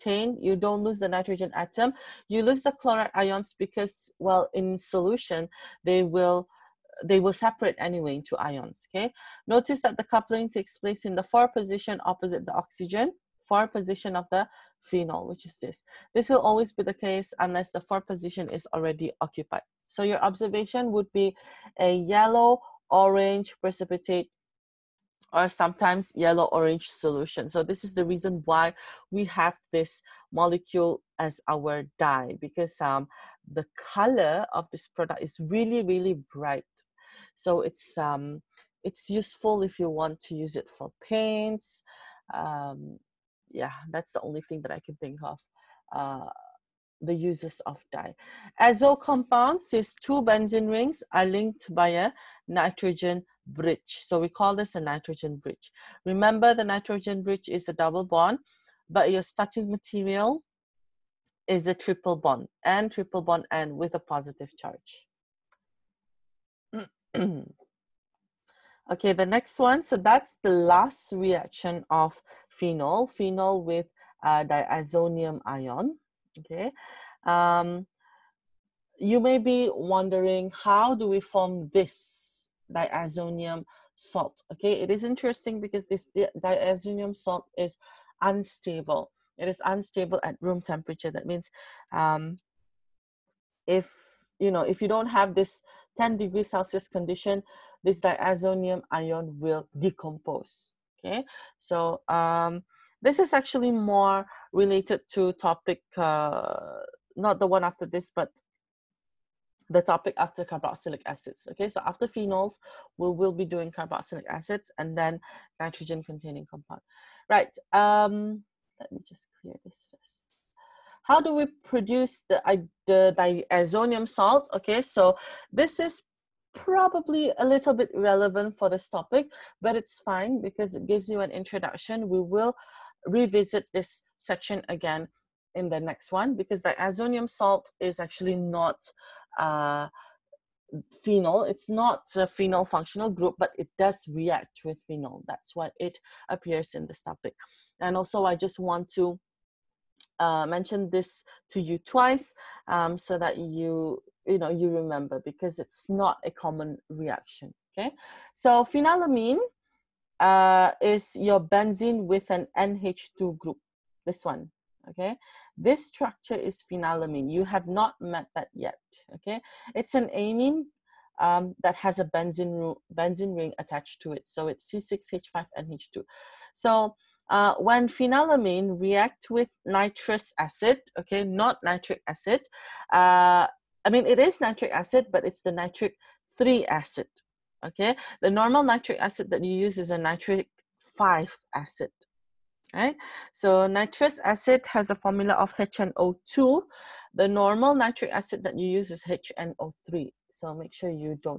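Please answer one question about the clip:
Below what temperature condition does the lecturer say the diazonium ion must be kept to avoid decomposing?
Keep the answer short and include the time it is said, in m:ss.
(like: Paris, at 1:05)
10 degrees Celsius, at 1:35.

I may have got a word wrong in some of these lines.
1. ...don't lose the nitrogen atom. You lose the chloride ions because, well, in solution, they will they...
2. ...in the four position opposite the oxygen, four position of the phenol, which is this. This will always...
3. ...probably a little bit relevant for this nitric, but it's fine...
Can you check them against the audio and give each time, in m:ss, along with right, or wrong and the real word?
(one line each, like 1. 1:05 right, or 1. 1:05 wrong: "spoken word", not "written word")
1. 0:00 right
2. 0:11 right
3. 2:06 wrong: "topic", not "nitric".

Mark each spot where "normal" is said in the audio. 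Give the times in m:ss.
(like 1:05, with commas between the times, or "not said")
3:08, 3:17.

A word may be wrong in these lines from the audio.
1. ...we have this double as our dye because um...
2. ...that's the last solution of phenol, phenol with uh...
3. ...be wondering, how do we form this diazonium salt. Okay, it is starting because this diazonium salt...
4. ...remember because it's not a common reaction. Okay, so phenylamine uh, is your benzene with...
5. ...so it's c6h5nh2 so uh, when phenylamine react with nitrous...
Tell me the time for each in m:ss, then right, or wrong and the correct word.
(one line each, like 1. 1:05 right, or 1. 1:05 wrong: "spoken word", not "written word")
1. 0:29 wrong: "molecule", not "double"
2. 1:09 wrong: "reaction", not "solution"
3. 1:19 wrong: "interesting", not "starting"
4. 2:34 right
5. 2:54 right.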